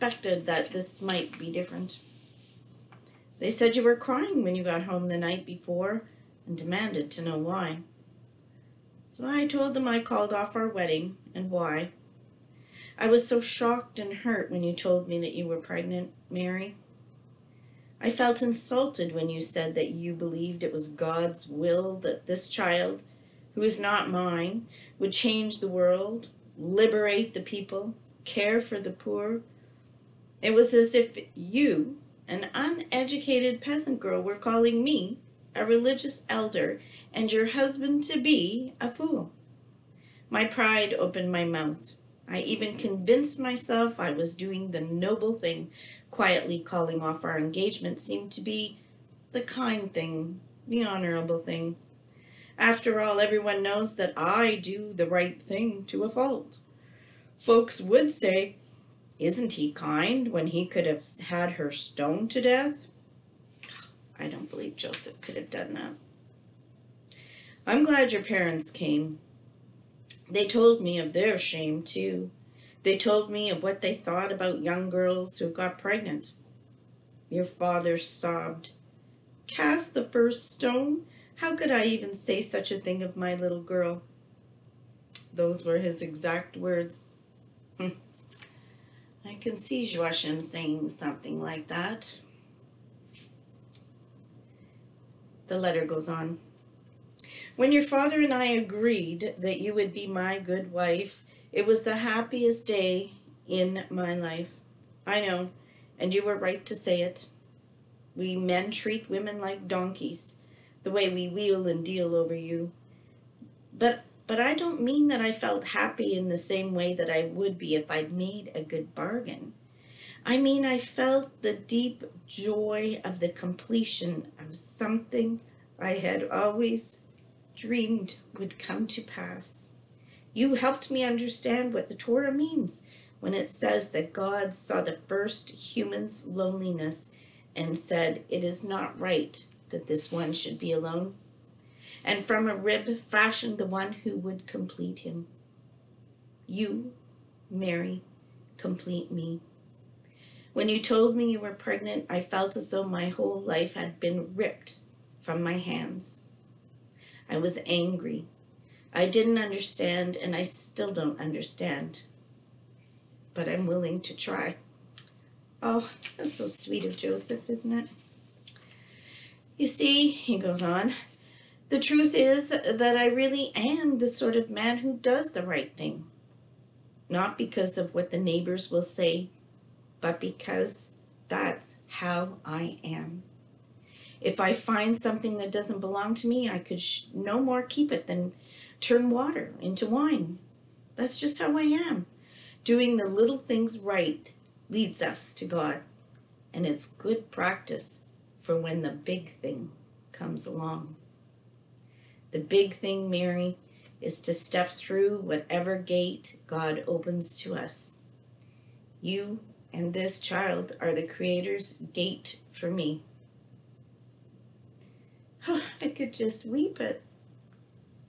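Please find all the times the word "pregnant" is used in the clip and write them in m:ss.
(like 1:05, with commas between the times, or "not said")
0:15, 1:15, 2:31.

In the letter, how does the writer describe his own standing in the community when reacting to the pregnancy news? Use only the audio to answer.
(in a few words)
A religious elder.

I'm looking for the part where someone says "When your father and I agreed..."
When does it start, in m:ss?
1:37.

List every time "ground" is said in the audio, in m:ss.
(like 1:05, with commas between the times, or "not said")
not said.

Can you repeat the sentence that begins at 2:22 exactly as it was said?
And from a rib fashioned the one who would complete him.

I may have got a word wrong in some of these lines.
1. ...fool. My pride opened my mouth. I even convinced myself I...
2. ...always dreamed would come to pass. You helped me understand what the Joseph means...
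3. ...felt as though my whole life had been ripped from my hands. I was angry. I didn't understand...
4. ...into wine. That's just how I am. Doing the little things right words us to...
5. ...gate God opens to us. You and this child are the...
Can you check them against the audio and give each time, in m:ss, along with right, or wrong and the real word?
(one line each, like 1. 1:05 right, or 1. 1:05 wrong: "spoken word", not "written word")
1. 0:38 right
2. 2:06 wrong: "Torah", not "Joseph"
3. 2:32 right
4. 3:09 wrong: "leads", not "words"
5. 3:25 right.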